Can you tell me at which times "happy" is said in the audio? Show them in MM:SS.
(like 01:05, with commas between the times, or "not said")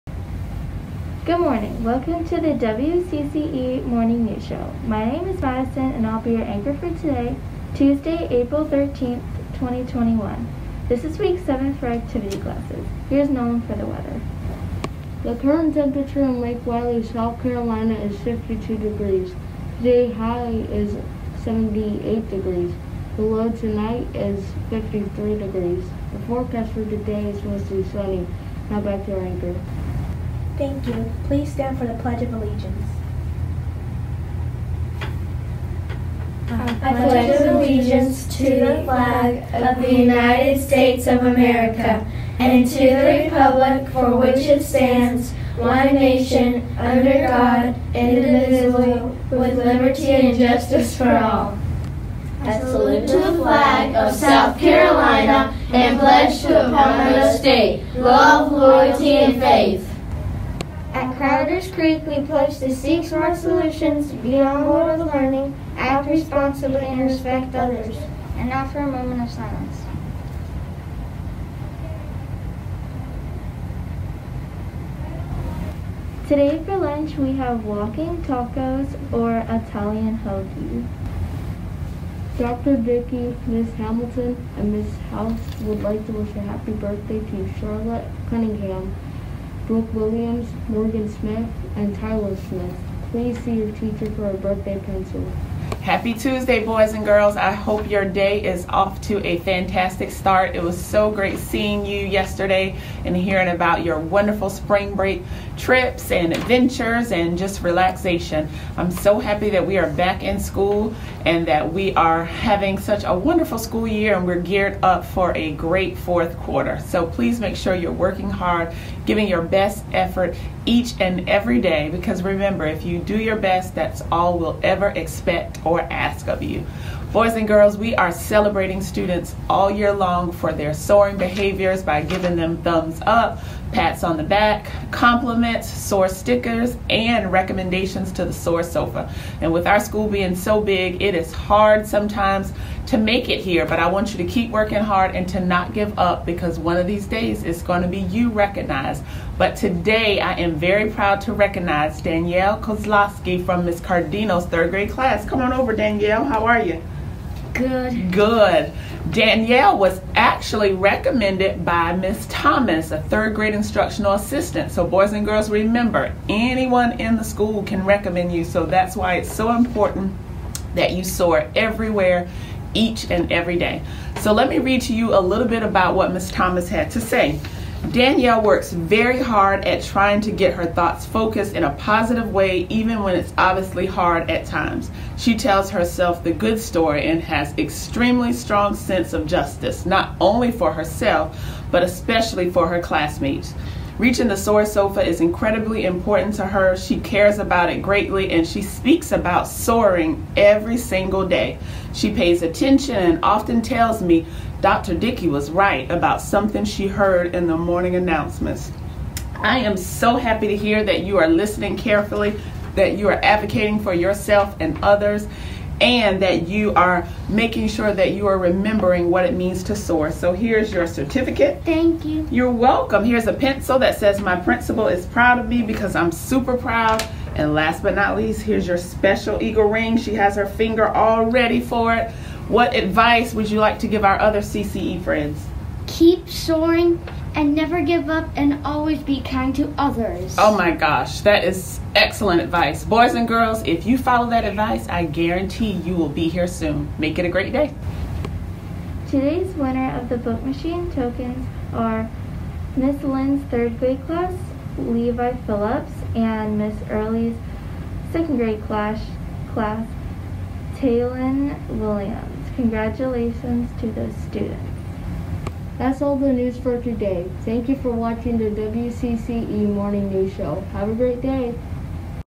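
01:26, 01:35, 01:49, 03:30.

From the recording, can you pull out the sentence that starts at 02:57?
Danielle works very hard at trying to get her thoughts focused in a positive way, even when it's obviously hard at times.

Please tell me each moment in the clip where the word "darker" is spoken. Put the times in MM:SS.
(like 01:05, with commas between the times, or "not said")
not said.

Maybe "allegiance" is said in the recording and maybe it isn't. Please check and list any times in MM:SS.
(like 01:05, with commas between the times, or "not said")
00:32, 00:37.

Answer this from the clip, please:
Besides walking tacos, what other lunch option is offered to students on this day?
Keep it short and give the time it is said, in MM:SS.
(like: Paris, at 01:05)
Italian hoagie, at 01:19.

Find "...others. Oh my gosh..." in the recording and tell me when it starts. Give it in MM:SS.
03:59.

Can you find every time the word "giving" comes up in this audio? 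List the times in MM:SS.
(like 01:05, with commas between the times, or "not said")
01:59, 02:12.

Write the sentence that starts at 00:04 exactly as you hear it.
My name is Madison and I'll be your anchor for today, Tuesday, April 13th, 2021.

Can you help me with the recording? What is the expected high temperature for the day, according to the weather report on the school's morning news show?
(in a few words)
78 degrees.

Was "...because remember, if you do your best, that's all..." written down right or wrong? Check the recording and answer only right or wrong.
right.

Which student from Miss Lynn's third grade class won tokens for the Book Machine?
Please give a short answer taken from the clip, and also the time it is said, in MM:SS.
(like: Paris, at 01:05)
Levi Phillips, at 04:14.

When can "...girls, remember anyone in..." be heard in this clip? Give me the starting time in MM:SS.
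02:45.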